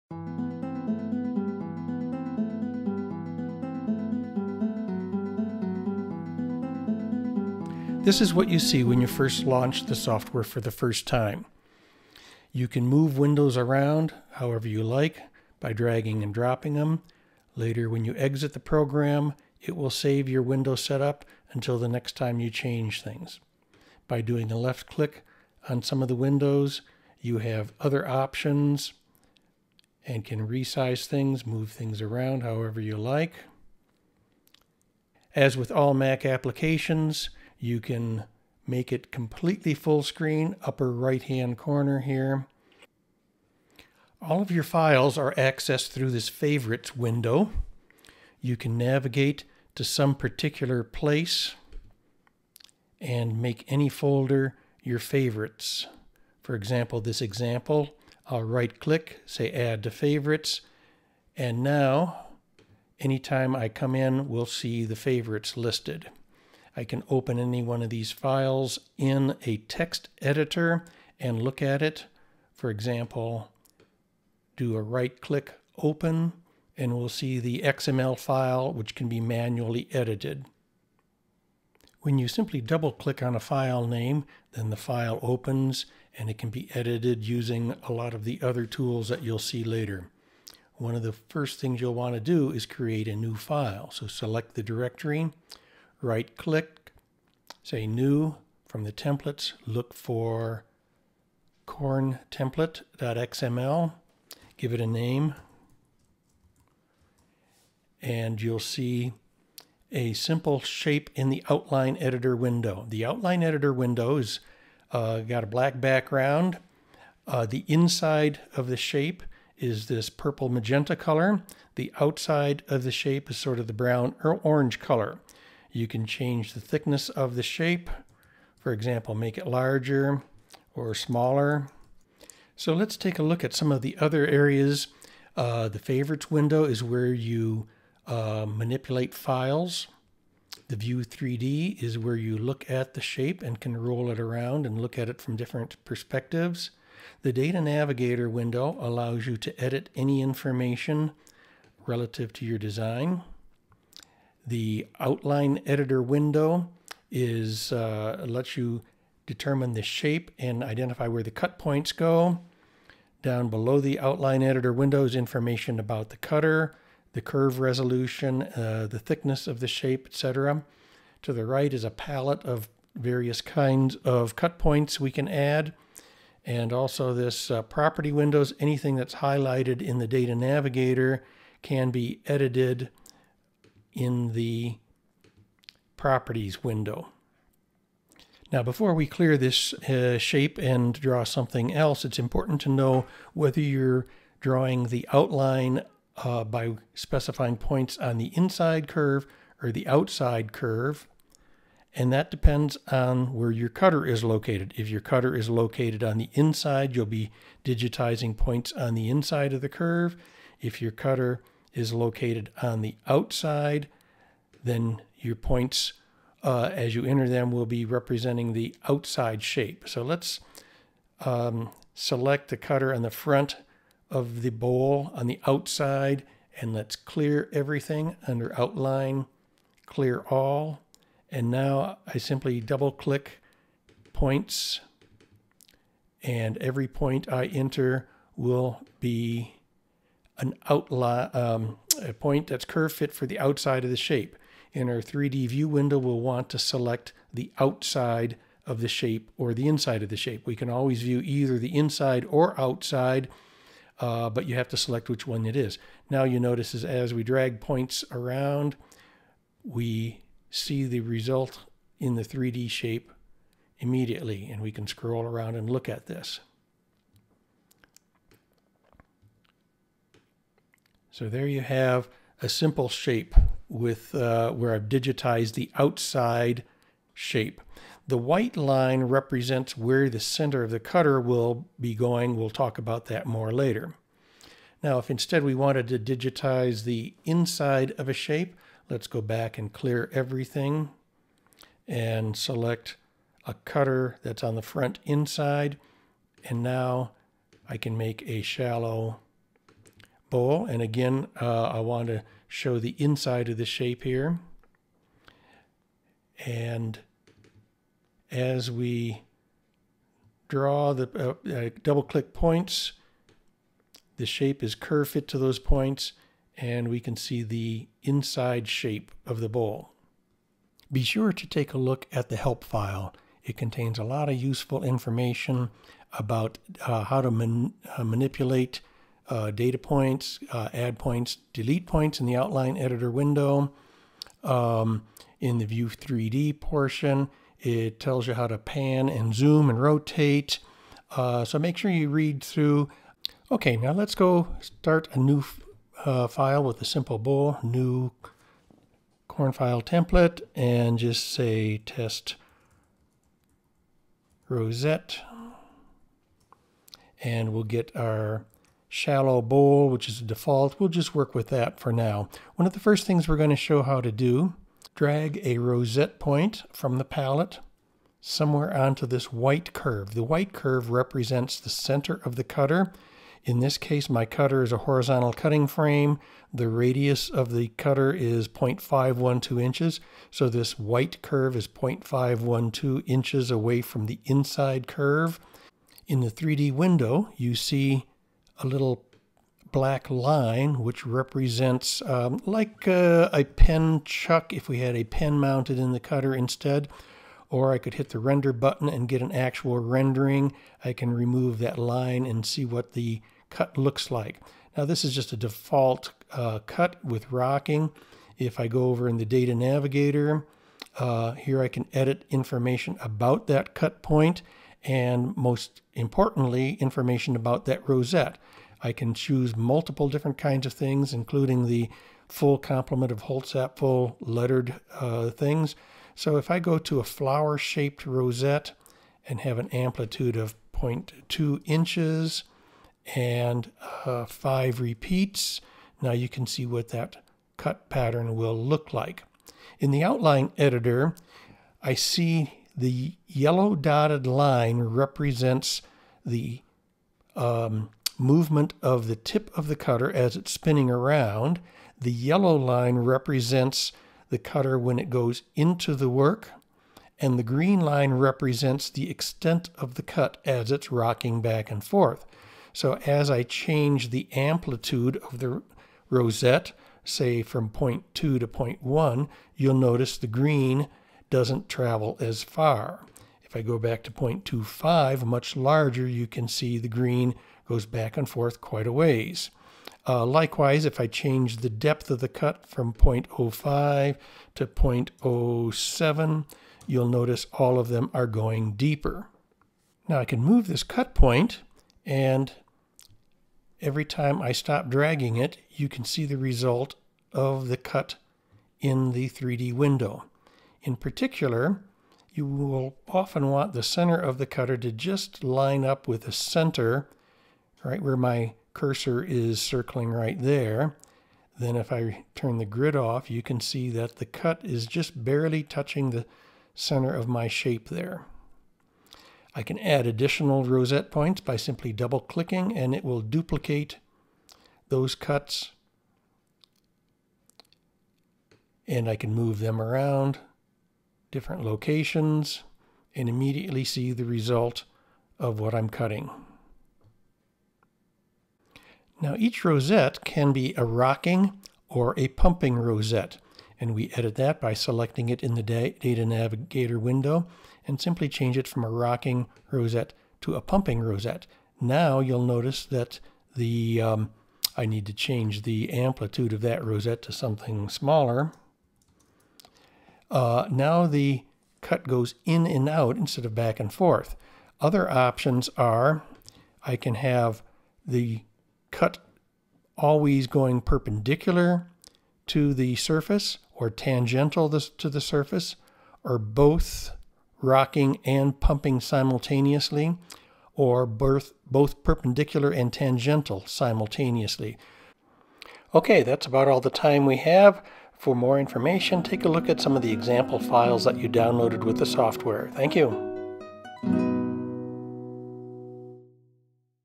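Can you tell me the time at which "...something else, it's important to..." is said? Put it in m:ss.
3:11.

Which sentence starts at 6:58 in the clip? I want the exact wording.
I can choose multiple different kinds of things, including the full complement of Holtzapfel lettered uh, things.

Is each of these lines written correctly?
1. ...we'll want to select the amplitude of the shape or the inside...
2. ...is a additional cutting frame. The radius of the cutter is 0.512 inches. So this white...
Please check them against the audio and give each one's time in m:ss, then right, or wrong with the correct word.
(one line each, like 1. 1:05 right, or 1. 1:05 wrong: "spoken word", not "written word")
1. 4:05 wrong: "outside", not "amplitude"
2. 6:14 wrong: "horizontal", not "additional".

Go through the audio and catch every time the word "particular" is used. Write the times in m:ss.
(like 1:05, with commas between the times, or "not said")
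0:50, 8:20.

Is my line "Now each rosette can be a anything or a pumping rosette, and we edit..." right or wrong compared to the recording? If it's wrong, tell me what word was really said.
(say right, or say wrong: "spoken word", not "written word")
wrong: "rocking", not "anything".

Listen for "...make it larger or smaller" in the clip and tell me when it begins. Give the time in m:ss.
2:09.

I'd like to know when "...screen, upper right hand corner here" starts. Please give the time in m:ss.
0:40.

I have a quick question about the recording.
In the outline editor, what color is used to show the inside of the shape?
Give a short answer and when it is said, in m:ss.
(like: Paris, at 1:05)
purple magenta, at 2:00.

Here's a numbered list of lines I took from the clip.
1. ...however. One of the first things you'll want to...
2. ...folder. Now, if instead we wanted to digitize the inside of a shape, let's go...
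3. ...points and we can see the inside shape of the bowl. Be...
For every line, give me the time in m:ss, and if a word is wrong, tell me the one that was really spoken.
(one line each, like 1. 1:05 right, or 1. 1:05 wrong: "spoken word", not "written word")
1. 1:29 wrong: "later", not "however"
2. 4:43 wrong: "later", not "folder"
3. 5:15 right.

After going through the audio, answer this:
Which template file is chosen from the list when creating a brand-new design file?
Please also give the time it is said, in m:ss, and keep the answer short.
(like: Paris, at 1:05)
corn template.xml, at 1:41.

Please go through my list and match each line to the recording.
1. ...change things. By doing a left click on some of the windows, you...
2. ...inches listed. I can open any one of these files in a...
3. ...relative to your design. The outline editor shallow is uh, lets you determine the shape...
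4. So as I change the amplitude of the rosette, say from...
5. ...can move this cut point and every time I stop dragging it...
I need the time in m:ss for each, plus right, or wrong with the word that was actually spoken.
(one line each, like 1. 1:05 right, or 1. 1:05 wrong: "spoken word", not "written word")
1. 0:22 right
2. 1:04 wrong: "favorites", not "inches"
3. 2:31 wrong: "window", not "shallow"
4. 7:42 right
5. 8:10 right.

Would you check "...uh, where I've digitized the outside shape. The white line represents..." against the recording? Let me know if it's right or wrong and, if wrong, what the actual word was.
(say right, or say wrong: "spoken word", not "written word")
right.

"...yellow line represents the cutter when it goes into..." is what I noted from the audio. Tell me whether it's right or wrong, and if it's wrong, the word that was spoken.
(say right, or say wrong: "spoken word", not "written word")
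right.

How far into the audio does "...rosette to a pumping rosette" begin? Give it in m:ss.
9:09.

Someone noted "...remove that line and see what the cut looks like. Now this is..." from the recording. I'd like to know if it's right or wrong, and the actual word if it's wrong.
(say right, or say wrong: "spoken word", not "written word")
right.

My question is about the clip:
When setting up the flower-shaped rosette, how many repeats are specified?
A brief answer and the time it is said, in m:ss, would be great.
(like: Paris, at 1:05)
5, at 7:14.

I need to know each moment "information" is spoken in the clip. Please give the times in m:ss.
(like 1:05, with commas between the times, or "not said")
2:30, 2:45, 5:24, 6:52, 6:56, 9:48.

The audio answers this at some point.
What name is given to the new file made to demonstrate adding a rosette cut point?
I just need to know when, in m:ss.
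5:51.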